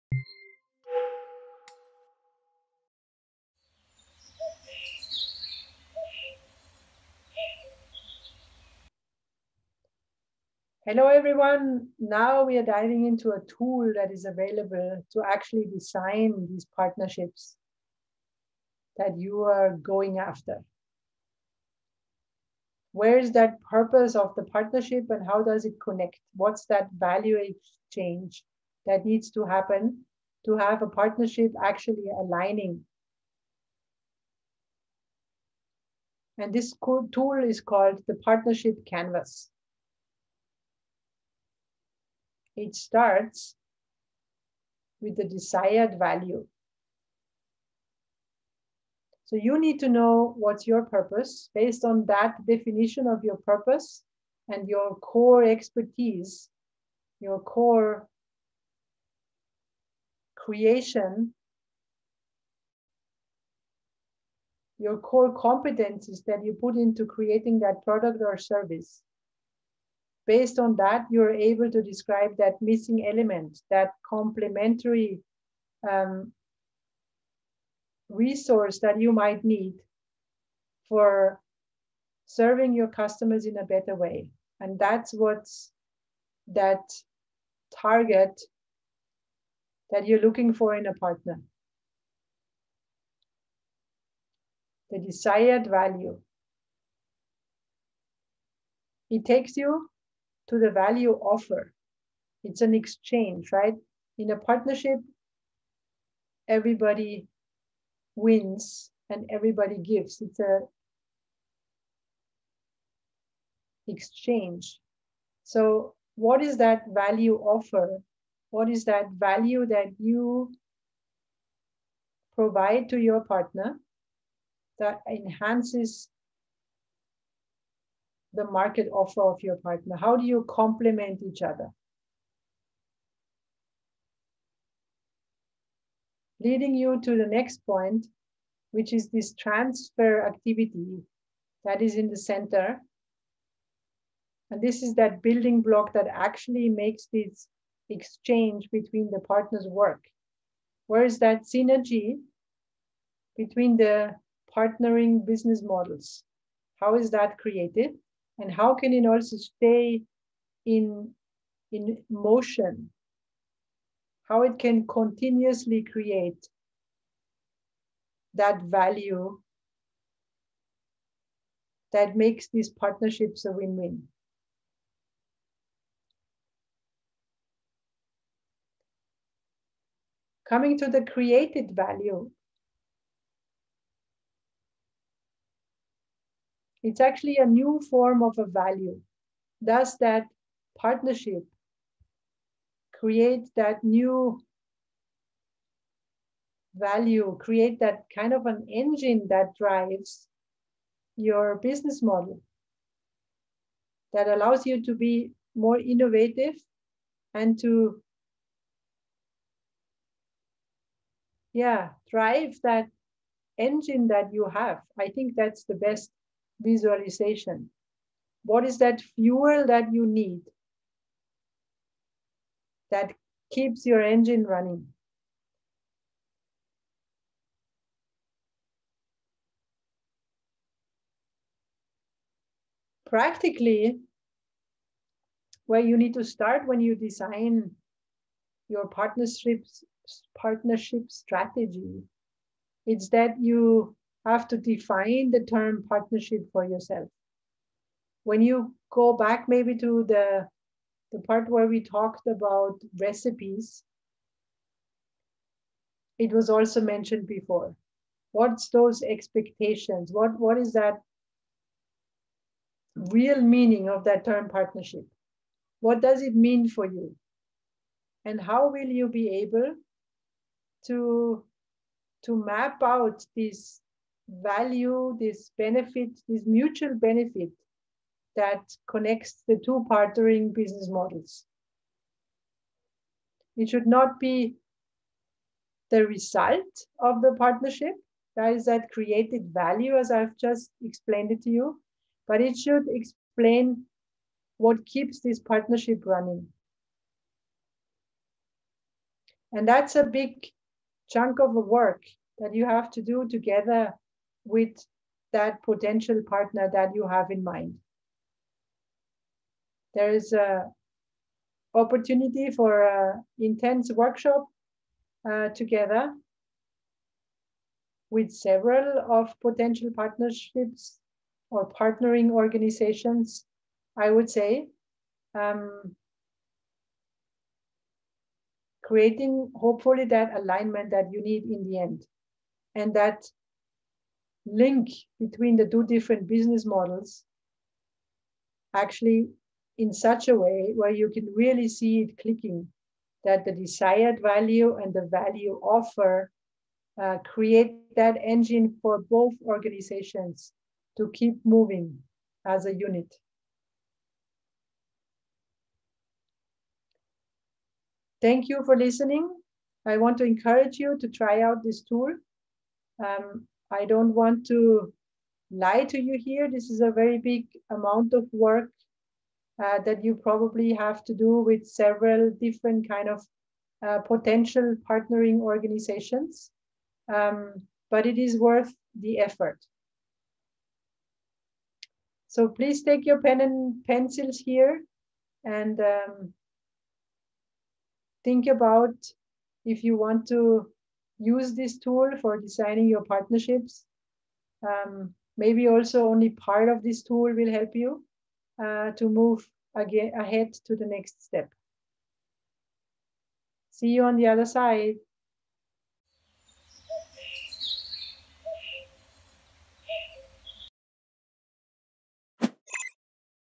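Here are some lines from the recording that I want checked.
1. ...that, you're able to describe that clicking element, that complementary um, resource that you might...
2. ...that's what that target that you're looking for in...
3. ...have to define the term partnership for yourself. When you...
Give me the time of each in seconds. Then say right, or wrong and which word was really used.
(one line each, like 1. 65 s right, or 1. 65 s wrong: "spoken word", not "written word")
1. 70 s wrong: "missing", not "clicking"
2. 84 s right
3. 244 s right.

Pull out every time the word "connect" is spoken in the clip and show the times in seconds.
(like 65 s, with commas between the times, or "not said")
25 s, 278 s.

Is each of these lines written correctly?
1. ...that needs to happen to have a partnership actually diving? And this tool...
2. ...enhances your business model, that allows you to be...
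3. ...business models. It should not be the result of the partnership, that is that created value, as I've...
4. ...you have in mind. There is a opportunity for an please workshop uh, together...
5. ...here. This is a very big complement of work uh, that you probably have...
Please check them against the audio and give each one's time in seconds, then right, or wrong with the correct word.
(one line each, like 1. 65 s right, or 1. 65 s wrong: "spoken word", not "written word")
1. 28 s wrong: "aligning", not "diving"
2. 199 s wrong: "drives", not "enhances"
3. 280 s right
4. 306 s wrong: "intense", not "please"
5. 366 s wrong: "amount", not "complement".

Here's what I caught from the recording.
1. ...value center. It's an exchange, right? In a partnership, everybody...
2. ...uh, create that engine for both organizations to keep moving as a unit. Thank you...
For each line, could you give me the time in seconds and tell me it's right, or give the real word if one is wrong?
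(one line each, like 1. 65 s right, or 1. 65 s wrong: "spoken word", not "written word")
1. 100 s wrong: "offer", not "center"
2. 347 s right.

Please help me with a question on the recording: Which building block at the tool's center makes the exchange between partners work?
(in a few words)
transfer activity.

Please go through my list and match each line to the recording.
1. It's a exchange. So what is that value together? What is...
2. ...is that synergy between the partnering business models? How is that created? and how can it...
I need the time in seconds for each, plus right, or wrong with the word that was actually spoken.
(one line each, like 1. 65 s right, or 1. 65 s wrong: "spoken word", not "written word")
1. 110 s wrong: "offer", not "together"
2. 151 s right.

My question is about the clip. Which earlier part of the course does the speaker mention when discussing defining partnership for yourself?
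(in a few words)
recipes.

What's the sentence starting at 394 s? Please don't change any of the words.
Um, maybe also only part of this tool will help you uh, to move again ahead to the next step.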